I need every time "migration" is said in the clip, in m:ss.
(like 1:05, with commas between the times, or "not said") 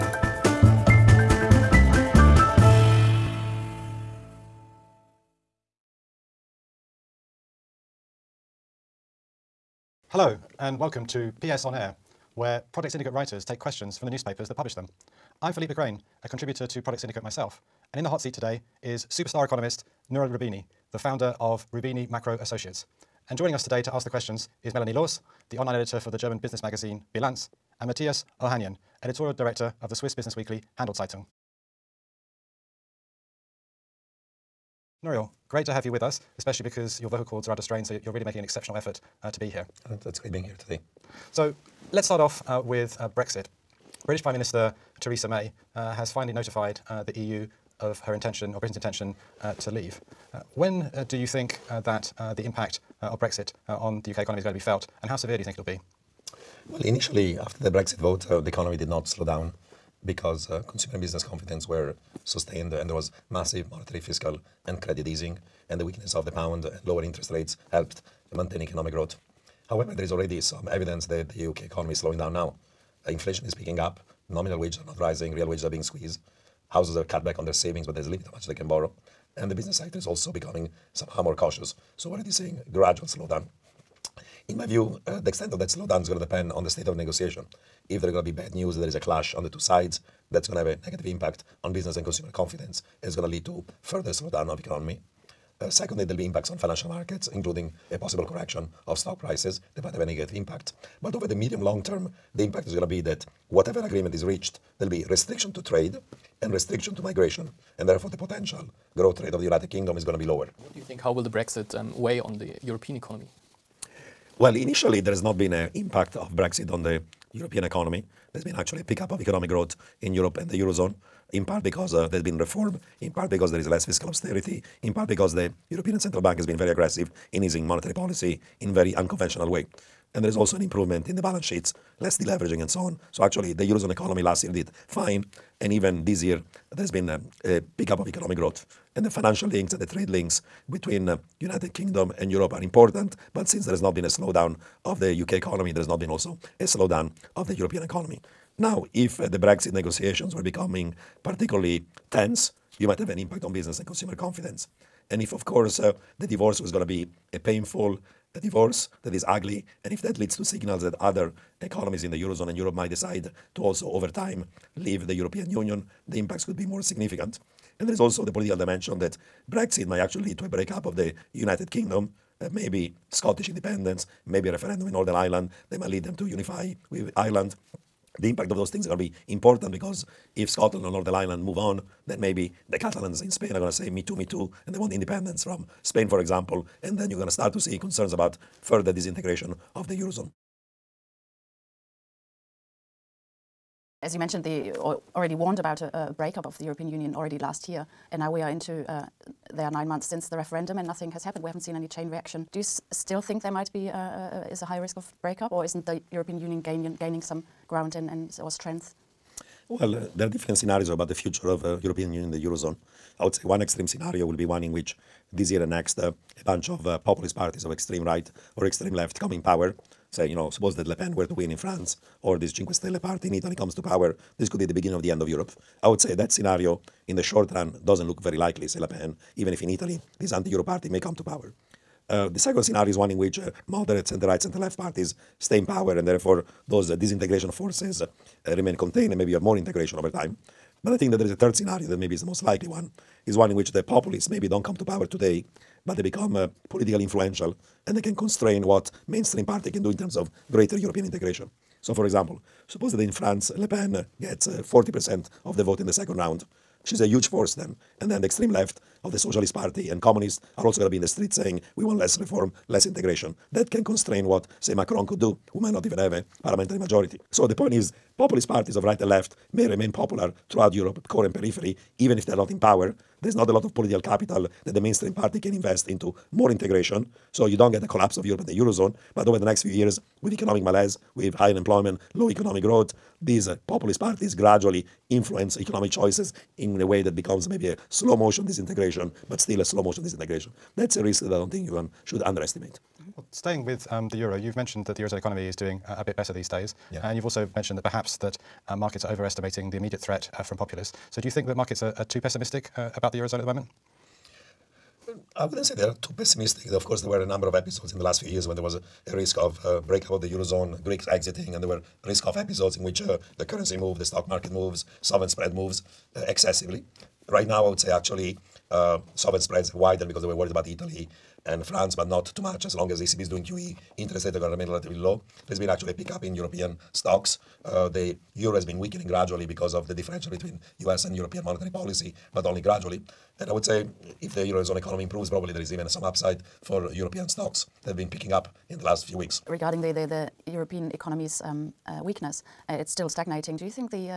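1:47.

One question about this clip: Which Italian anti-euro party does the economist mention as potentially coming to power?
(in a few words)
Cinque Stelle.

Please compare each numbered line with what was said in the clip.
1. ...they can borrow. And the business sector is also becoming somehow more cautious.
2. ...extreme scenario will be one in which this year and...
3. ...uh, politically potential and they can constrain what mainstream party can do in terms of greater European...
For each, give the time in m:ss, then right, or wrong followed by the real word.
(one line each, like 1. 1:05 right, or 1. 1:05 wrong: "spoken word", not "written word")
1. 1:18 right
2. 3:33 right
3. 4:06 wrong: "influential", not "potential".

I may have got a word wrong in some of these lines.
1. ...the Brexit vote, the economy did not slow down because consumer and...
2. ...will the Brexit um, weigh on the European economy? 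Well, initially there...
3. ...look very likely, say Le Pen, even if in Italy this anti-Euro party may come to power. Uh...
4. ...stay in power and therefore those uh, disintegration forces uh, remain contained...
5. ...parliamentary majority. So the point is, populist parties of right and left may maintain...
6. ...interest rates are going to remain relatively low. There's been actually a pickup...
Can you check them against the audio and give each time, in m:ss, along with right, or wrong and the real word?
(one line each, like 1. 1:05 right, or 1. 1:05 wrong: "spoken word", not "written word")
1. 0:57 right
2. 1:51 right
3. 3:48 right
4. 3:55 right
5. 4:26 wrong: "remain", not "maintain"
6. 5:23 right.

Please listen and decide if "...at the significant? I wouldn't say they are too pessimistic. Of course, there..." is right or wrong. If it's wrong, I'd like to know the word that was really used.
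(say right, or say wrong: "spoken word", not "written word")
wrong: "moment", not "significant".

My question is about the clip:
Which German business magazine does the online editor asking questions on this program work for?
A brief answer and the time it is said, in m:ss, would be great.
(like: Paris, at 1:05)
Bilanz, at 0:27.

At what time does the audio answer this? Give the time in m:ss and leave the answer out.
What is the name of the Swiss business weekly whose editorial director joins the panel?
0:30.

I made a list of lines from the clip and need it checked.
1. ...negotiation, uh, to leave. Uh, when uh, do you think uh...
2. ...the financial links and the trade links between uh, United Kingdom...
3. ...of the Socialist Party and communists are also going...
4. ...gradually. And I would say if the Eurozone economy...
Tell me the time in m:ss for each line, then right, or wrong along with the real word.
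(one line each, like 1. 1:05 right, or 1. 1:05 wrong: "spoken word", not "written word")
1. 0:48 wrong: "intention", not "negotiation"
2. 2:19 right
3. 4:19 right
4. 5:32 right.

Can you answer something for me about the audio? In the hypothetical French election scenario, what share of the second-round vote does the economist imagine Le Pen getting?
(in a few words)
40%.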